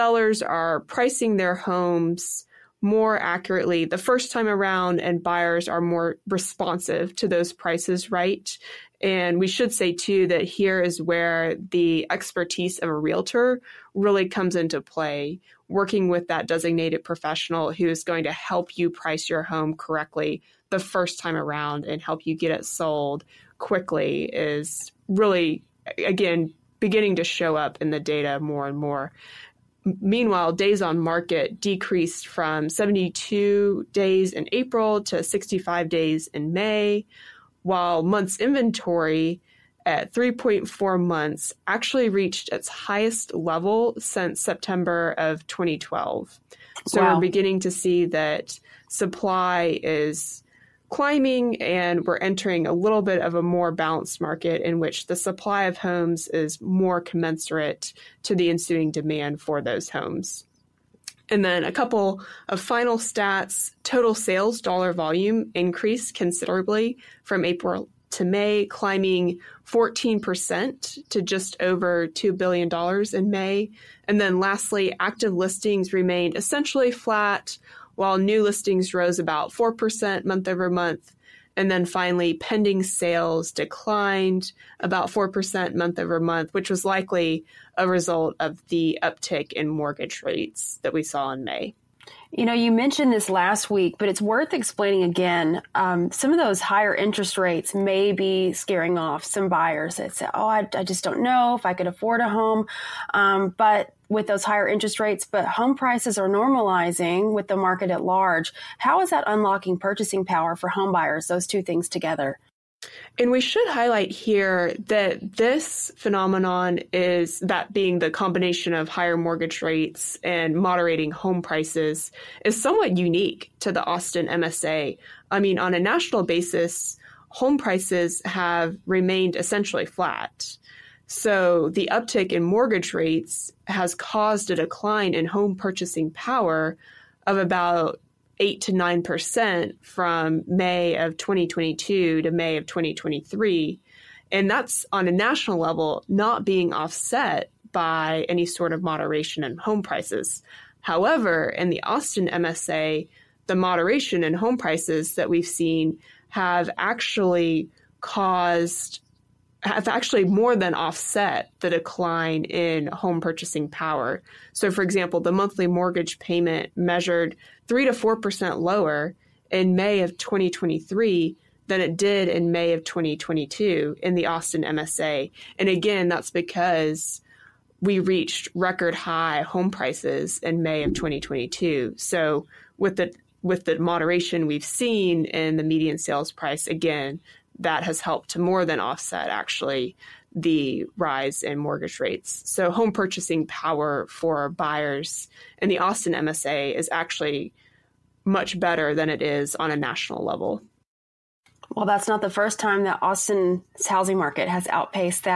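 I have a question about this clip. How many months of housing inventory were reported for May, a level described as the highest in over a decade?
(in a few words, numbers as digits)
3.4 months.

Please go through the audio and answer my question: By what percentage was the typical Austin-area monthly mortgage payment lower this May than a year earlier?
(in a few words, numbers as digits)
3 to 4%.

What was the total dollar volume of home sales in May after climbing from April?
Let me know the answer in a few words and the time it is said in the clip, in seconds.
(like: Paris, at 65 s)
just over $2 billion, at 71 s.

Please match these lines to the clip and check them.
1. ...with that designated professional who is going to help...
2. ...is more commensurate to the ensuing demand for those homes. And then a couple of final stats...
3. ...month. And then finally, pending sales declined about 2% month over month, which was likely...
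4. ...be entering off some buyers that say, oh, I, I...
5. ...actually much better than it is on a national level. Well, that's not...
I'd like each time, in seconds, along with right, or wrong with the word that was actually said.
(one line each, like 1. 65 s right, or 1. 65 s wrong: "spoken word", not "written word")
1. 16 s right
2. 56 s right
3. 80 s wrong: "4", not "2"
4. 98 s wrong: "scaring", not "entering"
5. 196 s right.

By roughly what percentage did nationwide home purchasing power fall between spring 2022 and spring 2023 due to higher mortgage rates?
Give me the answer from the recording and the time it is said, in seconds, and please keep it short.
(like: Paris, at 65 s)
8 to 9%, at 138 s.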